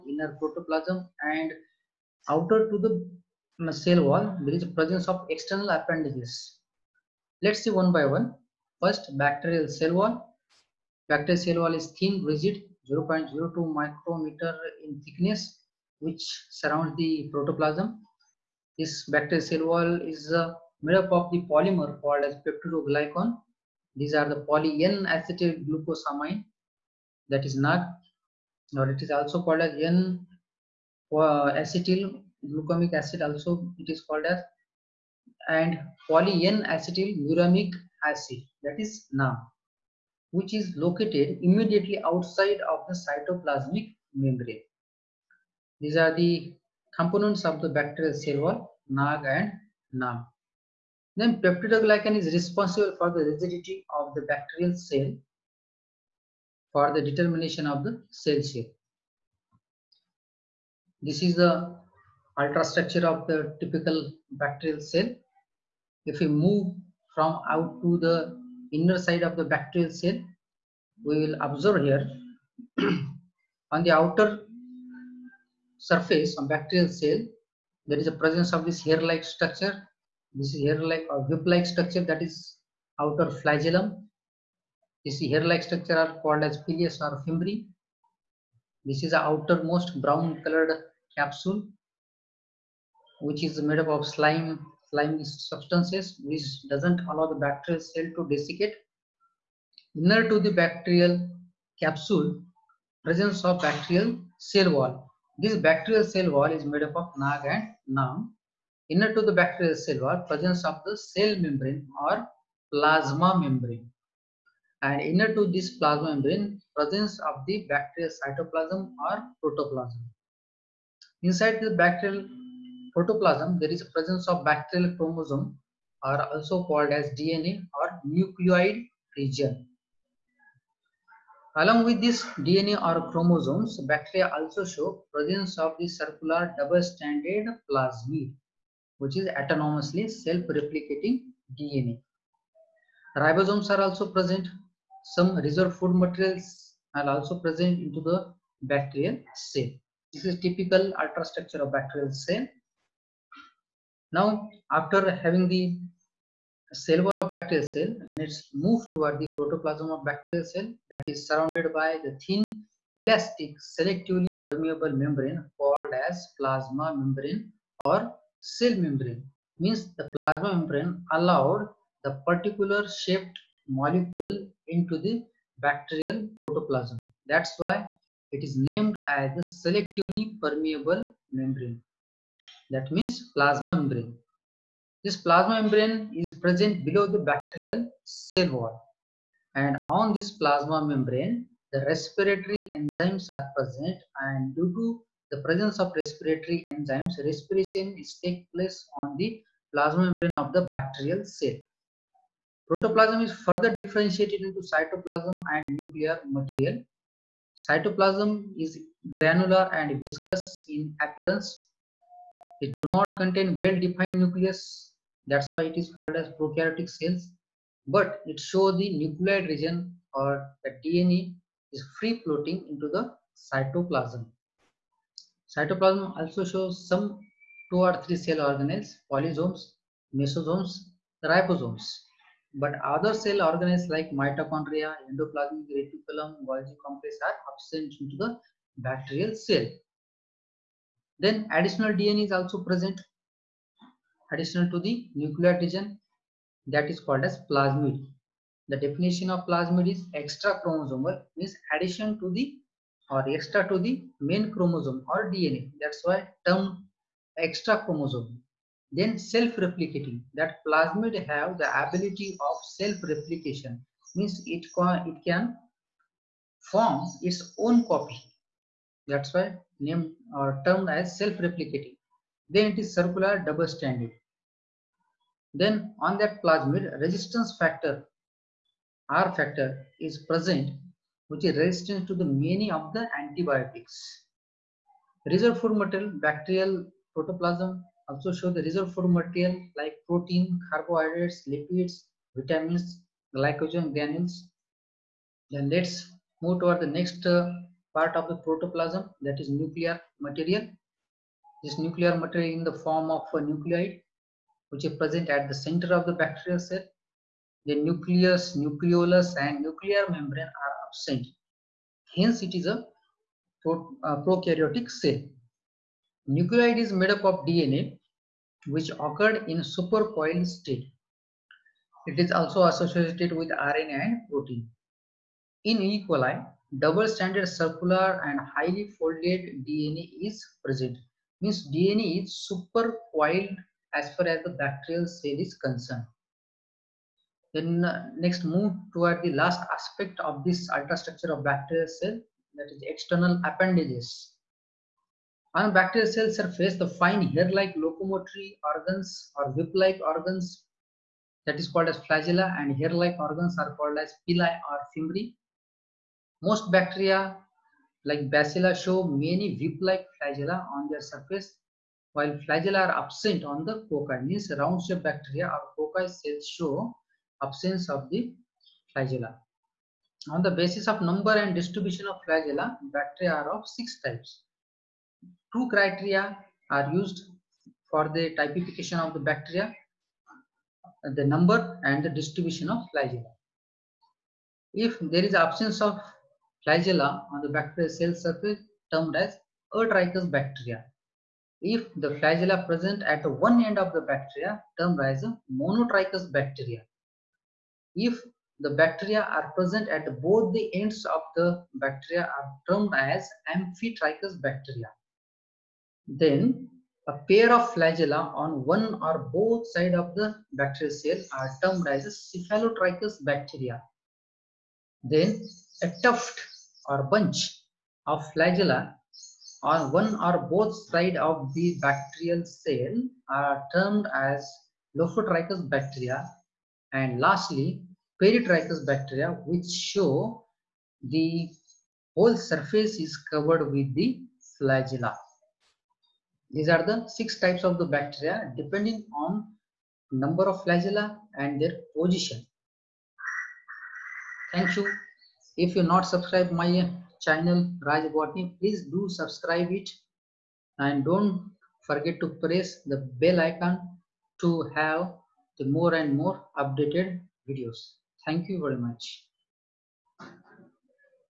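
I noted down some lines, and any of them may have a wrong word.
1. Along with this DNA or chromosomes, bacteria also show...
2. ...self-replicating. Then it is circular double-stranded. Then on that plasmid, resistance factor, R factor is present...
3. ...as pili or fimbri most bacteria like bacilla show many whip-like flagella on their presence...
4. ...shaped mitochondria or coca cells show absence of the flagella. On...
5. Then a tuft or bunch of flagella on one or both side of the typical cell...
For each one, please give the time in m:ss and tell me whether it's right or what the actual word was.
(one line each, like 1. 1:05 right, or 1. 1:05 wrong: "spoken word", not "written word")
1. 2:11 right
2. 4:31 right
3. 5:53 wrong: "surface", not "presence"
4. 6:04 wrong: "bacteria", not "mitochondria"
5. 6:55 wrong: "bacterial", not "typical".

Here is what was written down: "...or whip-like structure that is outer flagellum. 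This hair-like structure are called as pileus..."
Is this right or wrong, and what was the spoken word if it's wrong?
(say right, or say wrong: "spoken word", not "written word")
right.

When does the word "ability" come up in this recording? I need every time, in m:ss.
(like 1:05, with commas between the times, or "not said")
4:21.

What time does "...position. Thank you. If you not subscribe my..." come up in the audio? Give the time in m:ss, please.
7:21.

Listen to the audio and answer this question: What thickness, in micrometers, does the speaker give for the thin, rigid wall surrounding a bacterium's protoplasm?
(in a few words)
0.02 micrometer.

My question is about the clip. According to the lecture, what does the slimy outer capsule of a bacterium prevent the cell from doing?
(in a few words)
Desiccate.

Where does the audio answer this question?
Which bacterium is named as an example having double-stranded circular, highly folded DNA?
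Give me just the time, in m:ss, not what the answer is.
5:25.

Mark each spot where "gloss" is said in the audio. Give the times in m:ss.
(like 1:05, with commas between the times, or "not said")
not said.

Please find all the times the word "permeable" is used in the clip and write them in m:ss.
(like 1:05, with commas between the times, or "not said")
2:44, 3:00.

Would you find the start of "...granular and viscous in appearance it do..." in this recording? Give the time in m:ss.
3:29.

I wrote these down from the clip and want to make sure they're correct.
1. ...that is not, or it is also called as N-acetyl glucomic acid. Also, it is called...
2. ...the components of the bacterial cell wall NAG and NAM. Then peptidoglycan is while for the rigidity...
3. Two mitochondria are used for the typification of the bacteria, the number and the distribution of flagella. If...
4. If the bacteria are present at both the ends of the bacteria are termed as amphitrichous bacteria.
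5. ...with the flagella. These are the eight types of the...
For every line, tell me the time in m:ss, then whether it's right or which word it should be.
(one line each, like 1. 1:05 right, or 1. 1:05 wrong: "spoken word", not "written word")
1. 0:27 right
2. 0:46 wrong: "responsible", not "while"
3. 6:15 wrong: "criteria", not "mitochondria"
4. 6:37 right
5. 7:13 wrong: "six", not "eight".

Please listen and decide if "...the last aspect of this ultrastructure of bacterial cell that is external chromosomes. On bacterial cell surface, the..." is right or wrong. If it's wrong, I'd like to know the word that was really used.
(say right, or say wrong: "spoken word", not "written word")
wrong: "appendages", not "chromosomes".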